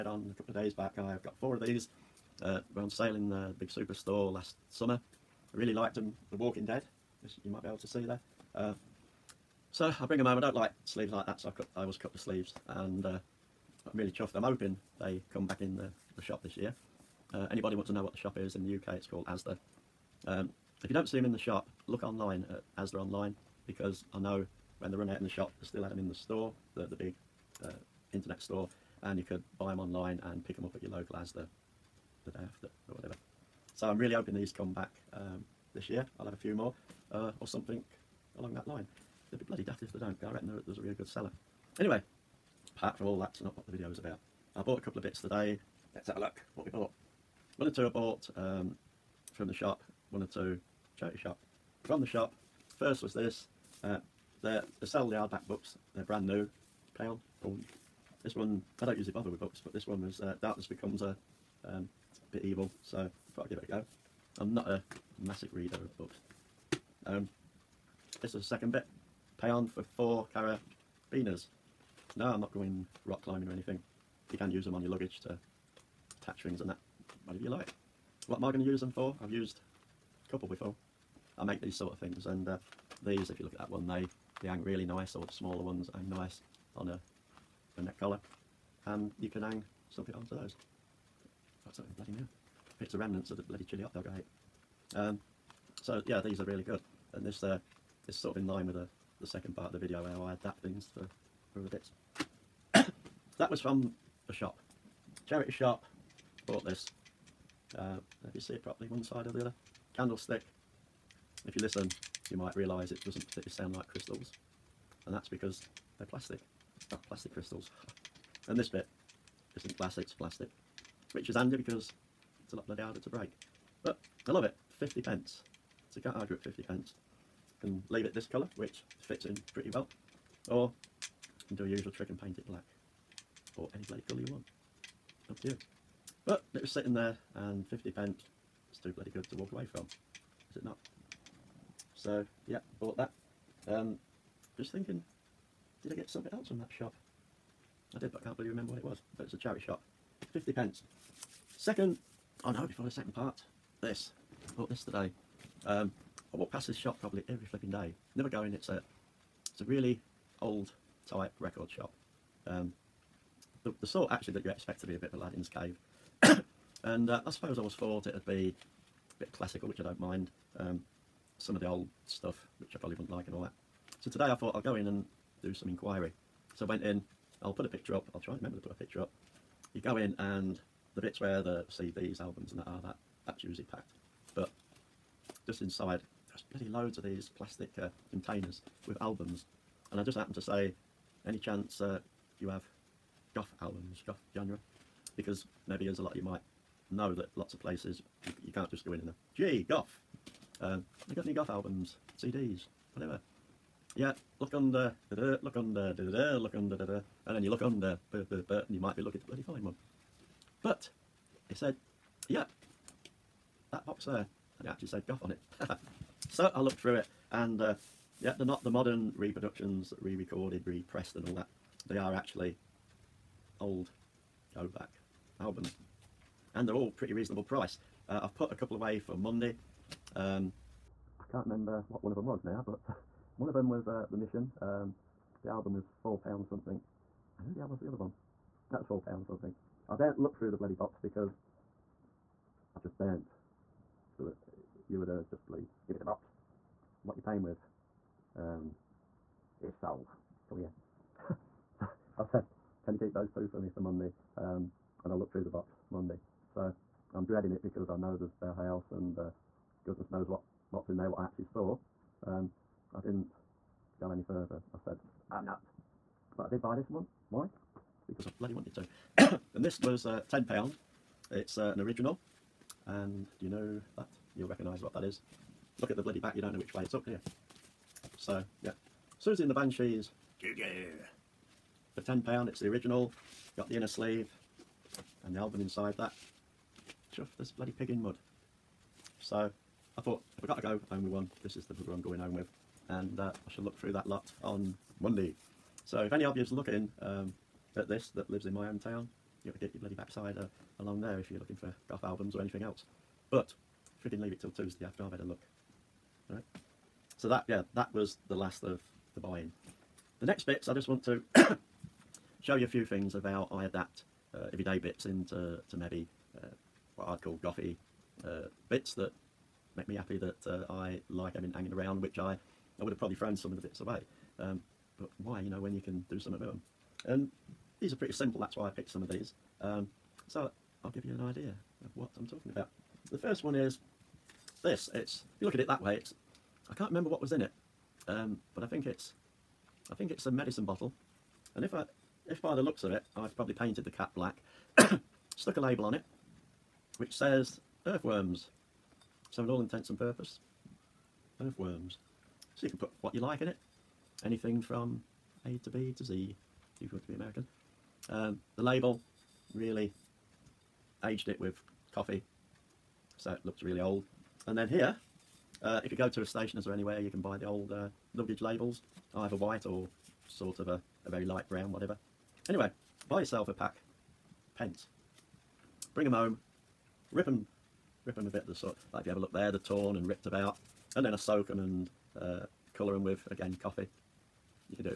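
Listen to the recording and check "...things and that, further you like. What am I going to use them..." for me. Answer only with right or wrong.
wrong.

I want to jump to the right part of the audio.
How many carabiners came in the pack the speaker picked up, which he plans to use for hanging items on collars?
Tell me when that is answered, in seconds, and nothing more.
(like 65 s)
69 s.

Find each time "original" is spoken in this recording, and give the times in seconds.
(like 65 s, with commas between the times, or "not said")
271 s, 282 s.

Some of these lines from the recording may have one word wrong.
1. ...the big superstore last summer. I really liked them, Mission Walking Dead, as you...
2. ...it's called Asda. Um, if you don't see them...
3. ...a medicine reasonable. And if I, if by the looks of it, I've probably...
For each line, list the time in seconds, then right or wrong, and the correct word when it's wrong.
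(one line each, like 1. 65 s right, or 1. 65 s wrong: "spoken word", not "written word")
1. 3 s wrong: "The", not "Mission"
2. 18 s right
3. 340 s wrong: "bottle", not "reasonable".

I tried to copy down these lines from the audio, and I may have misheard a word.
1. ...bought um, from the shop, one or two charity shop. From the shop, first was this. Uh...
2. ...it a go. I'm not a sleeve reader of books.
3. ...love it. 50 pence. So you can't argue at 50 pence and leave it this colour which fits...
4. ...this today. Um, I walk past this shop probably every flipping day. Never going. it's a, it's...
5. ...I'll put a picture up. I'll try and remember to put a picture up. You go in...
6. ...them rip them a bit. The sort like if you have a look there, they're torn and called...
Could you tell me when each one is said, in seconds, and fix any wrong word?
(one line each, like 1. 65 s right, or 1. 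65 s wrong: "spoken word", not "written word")
1. 47 s right
2. 63 s wrong: "massive", not "sleeve"
3. 124 s right
4. 154 s right
5. 177 s right
6. 377 s wrong: "ripped", not "called".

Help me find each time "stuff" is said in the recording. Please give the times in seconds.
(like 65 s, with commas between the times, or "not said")
172 s.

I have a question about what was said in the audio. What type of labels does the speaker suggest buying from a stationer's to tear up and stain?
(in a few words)
luggage labels.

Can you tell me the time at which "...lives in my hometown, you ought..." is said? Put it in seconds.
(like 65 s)
298 s.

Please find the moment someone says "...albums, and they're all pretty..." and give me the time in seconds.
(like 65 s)
225 s.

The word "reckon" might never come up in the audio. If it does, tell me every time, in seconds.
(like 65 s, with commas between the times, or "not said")
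40 s.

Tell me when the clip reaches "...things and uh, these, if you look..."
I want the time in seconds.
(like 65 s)
81 s.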